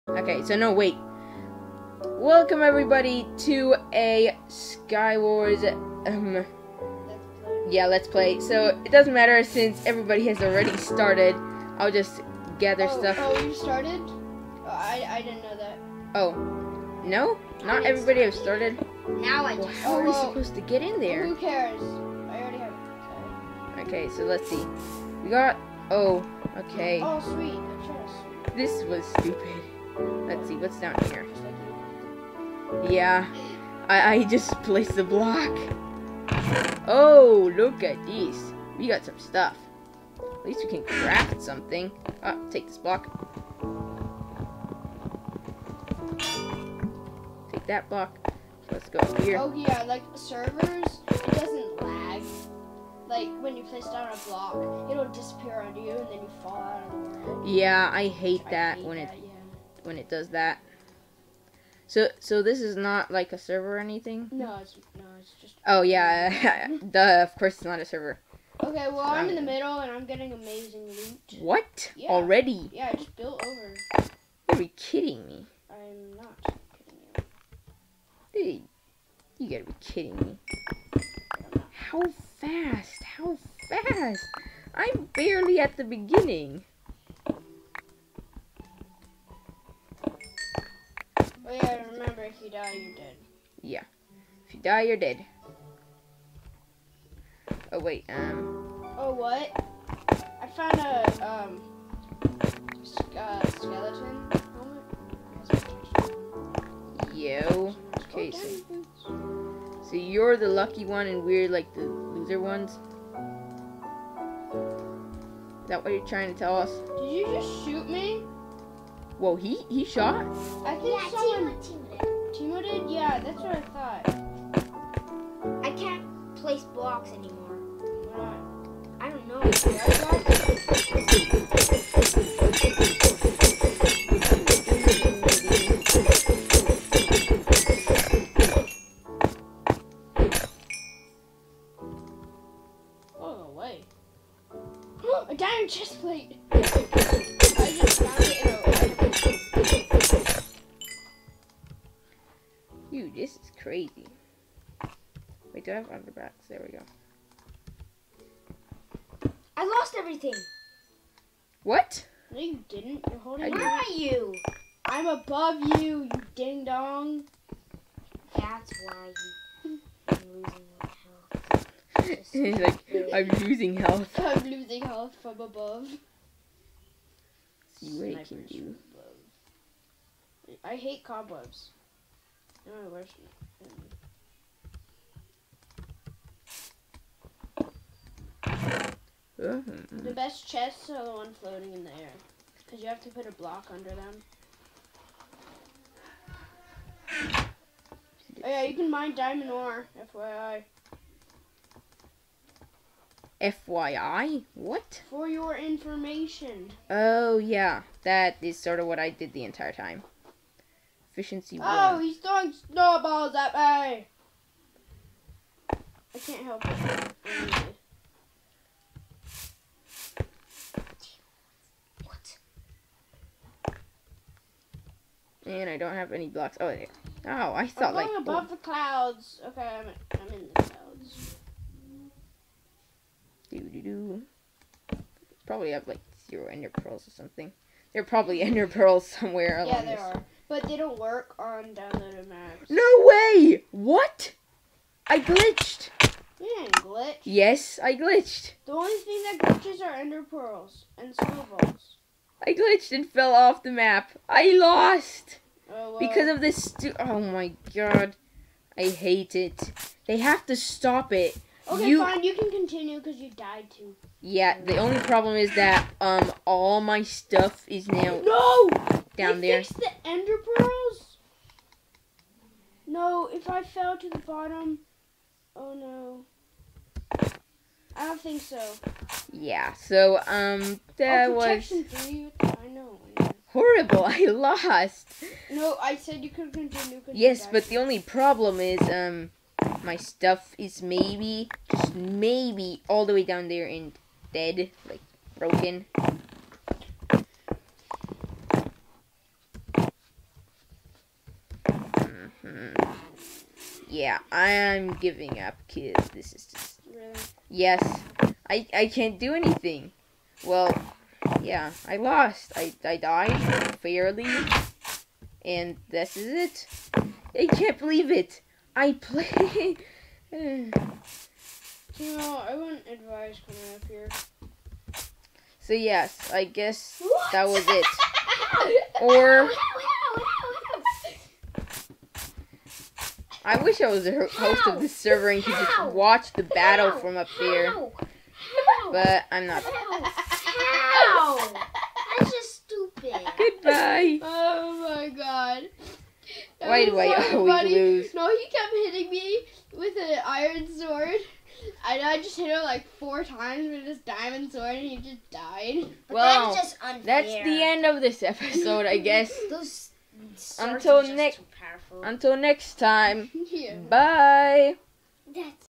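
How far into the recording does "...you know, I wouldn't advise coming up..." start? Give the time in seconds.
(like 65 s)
320 s.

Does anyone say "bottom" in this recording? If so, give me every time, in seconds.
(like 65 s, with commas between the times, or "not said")
274 s.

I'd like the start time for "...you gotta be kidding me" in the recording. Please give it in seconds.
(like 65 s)
79 s.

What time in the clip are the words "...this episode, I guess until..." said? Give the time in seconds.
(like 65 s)
358 s.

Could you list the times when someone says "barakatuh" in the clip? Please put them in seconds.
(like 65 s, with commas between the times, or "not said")
not said.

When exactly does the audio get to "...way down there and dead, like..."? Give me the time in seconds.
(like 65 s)
293 s.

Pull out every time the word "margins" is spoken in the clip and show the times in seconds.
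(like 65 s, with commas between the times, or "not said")
not said.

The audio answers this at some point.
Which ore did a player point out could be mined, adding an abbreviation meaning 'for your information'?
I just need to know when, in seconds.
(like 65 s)
199 s.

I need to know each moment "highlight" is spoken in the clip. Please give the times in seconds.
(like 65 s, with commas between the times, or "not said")
not said.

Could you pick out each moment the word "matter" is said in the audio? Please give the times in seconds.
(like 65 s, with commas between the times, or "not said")
9 s.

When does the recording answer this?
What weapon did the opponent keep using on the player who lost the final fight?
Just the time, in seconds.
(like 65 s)
350 s.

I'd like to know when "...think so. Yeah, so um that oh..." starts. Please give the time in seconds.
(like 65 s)
278 s.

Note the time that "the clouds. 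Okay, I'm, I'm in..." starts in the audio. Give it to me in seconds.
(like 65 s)
228 s.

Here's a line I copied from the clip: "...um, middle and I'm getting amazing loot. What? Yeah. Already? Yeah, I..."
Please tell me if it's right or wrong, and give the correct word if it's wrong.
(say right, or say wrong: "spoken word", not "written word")
right.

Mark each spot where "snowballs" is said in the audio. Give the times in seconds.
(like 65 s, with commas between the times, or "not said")
212 s, 251 s.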